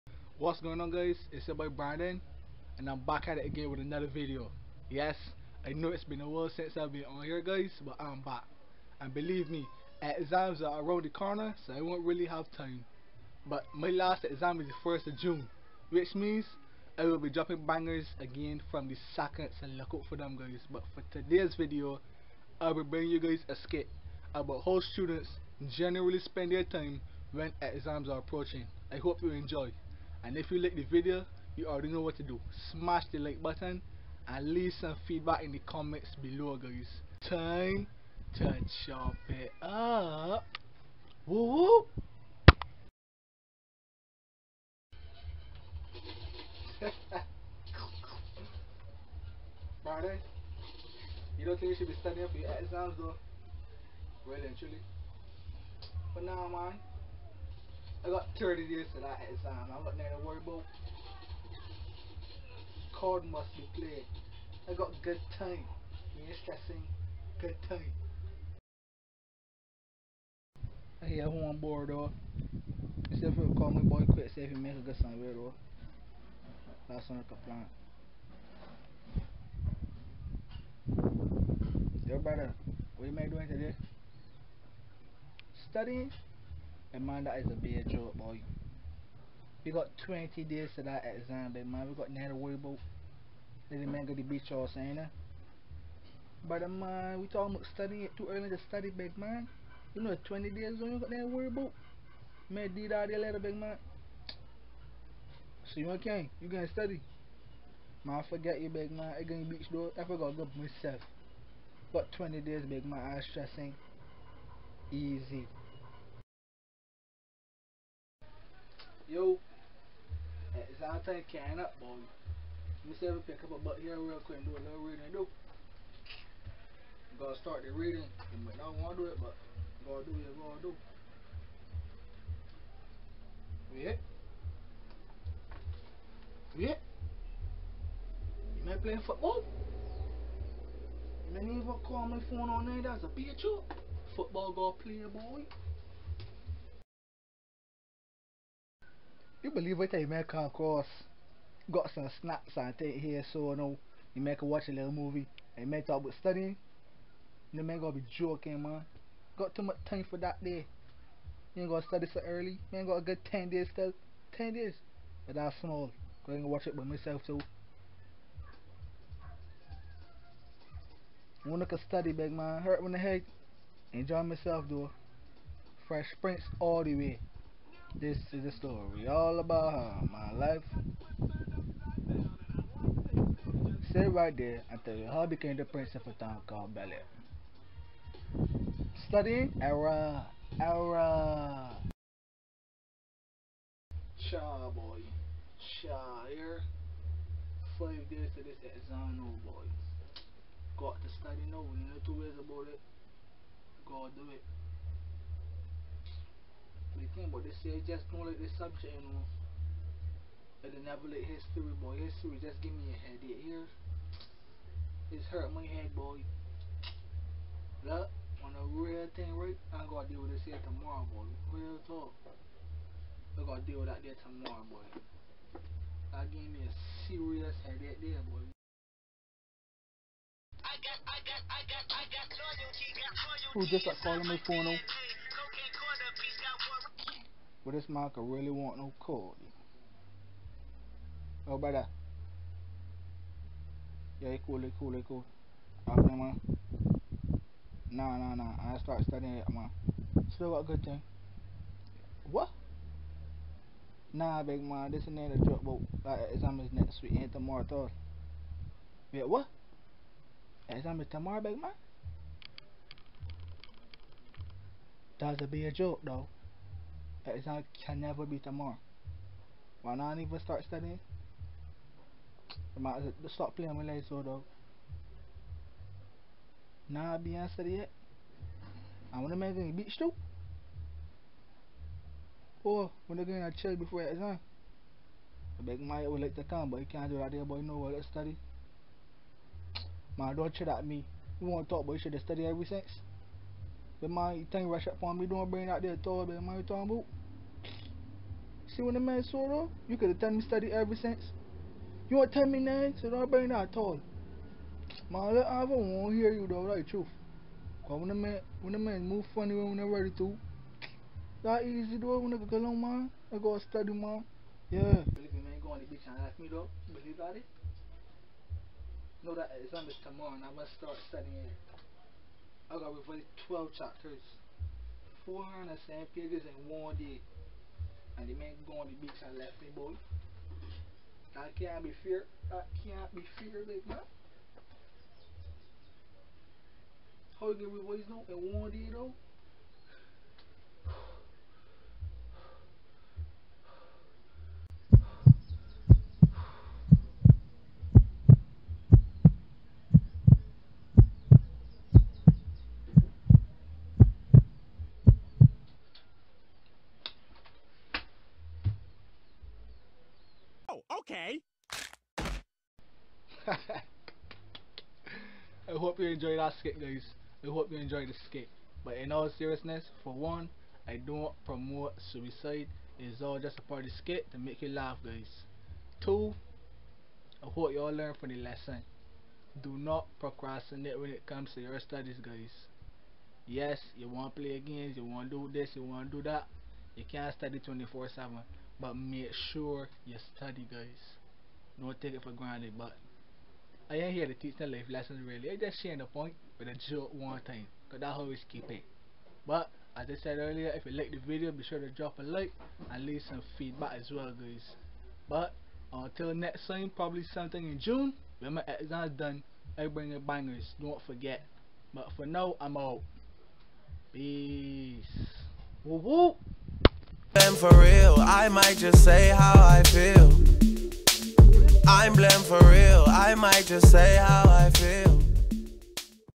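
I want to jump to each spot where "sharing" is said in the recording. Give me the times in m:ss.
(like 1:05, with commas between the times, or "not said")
6:35.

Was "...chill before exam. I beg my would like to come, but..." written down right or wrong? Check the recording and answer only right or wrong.
right.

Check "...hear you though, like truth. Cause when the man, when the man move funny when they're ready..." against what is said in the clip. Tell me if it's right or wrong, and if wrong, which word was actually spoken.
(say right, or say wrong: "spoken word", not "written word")
right.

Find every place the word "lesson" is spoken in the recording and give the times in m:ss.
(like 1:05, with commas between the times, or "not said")
6:18, 6:34.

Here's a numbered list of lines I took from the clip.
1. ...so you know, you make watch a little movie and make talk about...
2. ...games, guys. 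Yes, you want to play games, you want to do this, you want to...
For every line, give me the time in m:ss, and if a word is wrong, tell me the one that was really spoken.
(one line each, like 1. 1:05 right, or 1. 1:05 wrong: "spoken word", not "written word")
1. 2:33 right
2. 6:21 wrong: "studies", not "games".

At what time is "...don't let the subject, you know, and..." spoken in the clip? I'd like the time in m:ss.
3:28.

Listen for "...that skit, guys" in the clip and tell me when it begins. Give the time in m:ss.
6:06.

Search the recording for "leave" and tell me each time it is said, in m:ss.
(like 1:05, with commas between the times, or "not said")
0:34, 6:43.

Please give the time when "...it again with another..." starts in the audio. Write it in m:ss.
0:03.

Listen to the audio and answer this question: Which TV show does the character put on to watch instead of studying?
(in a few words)
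Fresh Prince.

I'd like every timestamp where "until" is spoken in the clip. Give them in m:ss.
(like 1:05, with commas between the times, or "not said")
3:04, 6:45.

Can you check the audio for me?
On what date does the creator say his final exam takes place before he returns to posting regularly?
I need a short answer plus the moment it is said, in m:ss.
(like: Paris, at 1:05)
1st of June, at 0:14.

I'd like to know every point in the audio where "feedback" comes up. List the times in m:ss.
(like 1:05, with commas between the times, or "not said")
0:35, 6:43.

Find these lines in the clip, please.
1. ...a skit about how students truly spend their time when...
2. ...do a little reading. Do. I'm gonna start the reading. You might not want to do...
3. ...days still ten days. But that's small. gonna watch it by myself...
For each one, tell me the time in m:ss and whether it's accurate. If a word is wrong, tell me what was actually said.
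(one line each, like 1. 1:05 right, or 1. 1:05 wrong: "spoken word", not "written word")
1. 0:23 wrong: "generally", not "truly"
2. 2:04 right
3. 2:43 right.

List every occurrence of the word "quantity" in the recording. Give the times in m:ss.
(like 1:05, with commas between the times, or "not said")
not said.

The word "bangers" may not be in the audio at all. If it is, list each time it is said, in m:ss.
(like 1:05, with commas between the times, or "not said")
0:17, 6:50.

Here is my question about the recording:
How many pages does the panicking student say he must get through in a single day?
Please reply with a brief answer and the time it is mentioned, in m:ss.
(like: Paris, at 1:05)
407, at 5:25.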